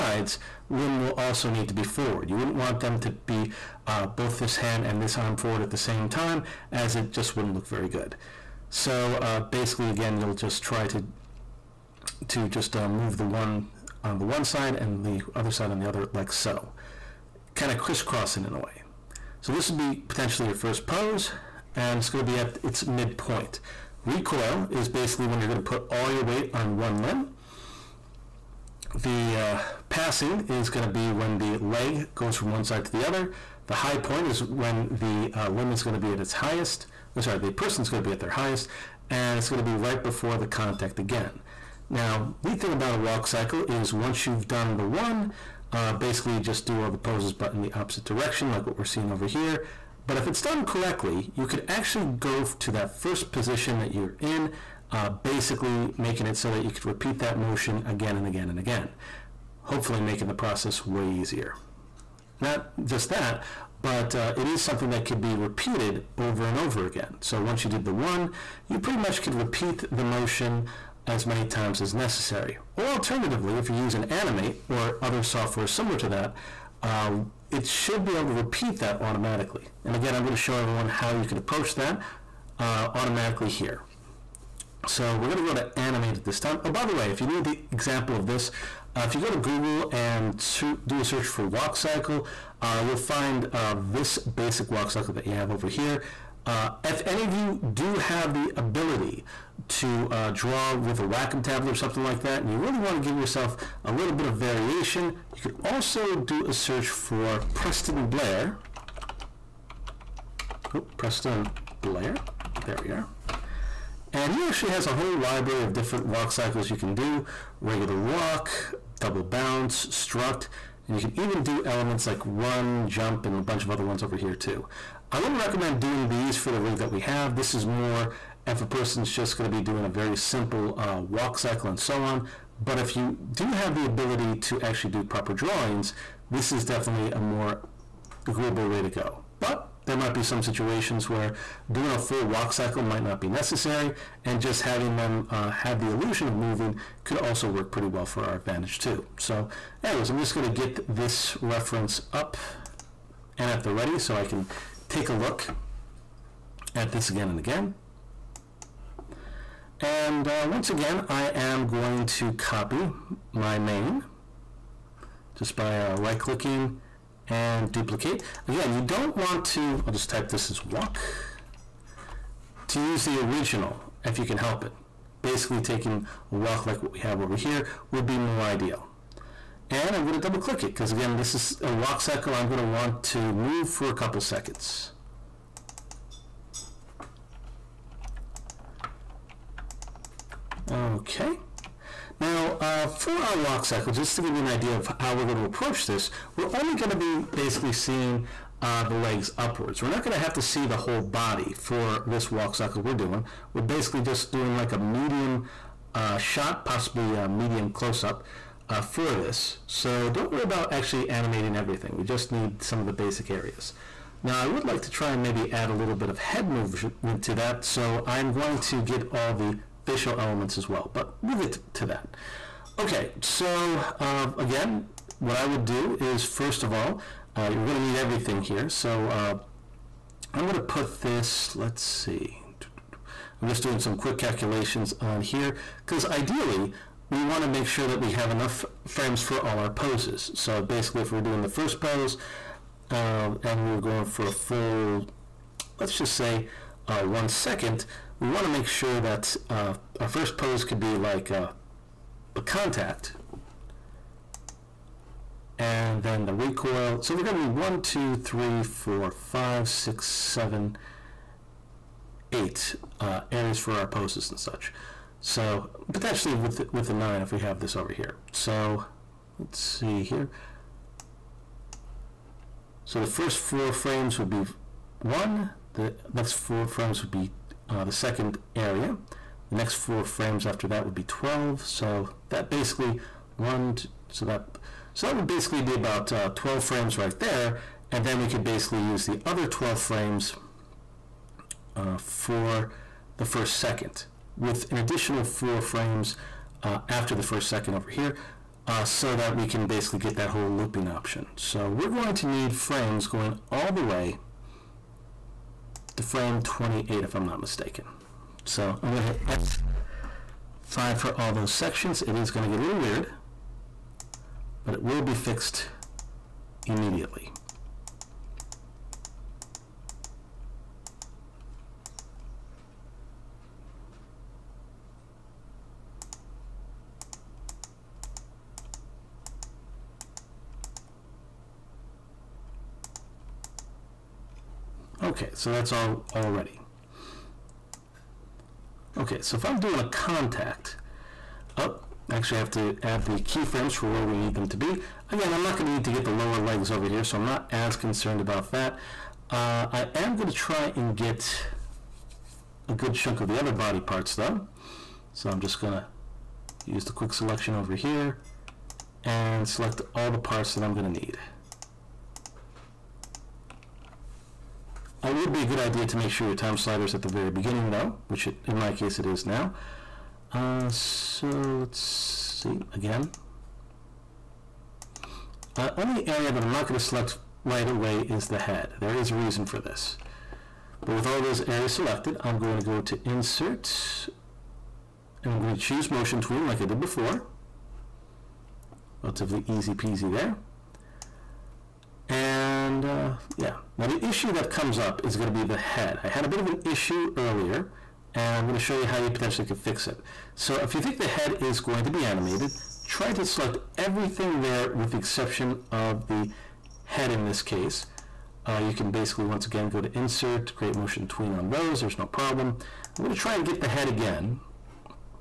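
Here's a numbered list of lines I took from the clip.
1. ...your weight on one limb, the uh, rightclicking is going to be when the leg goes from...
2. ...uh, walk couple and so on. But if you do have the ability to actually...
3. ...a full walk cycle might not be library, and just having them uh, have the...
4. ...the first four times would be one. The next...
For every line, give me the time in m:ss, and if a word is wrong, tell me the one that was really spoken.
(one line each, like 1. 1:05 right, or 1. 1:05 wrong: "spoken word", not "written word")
1. 0:26 wrong: "passing", not "rightclicking"
2. 2:10 wrong: "cycle", not "couple"
3. 2:21 wrong: "necessary", not "library"
4. 4:32 wrong: "frames", not "times".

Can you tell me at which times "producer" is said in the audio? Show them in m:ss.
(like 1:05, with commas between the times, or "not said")
not said.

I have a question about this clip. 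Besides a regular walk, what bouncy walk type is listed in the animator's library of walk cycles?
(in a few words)
double bounce.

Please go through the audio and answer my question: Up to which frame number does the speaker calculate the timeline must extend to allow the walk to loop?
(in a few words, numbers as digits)
28.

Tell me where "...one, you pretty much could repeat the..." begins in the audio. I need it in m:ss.
1:07.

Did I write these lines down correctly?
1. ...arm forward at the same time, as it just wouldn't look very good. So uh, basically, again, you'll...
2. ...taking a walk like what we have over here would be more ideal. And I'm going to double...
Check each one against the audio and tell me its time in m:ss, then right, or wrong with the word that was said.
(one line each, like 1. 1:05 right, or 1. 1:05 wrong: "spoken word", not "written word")
1. 0:05 right
2. 2:55 right.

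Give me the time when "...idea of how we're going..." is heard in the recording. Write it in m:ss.
3:14.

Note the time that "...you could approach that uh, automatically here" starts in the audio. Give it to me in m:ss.
1:21.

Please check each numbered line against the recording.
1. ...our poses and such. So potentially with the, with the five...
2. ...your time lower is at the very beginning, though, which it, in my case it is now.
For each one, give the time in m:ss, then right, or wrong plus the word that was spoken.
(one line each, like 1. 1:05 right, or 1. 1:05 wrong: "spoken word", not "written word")
1. 4:23 wrong: "nine", not "five"
2. 6:06 wrong: "slider", not "lower".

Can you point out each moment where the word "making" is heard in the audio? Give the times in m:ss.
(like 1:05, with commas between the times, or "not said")
0:55, 1:00.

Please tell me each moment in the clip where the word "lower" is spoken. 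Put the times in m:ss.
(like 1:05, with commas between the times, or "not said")
5:46.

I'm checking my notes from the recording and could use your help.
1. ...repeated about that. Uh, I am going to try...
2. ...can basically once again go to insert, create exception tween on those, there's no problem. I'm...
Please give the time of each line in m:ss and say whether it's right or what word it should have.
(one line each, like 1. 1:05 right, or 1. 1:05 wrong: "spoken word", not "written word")
1. 5:47 wrong: "concerned", not "repeated"
2. 6:48 wrong: "motion", not "exception".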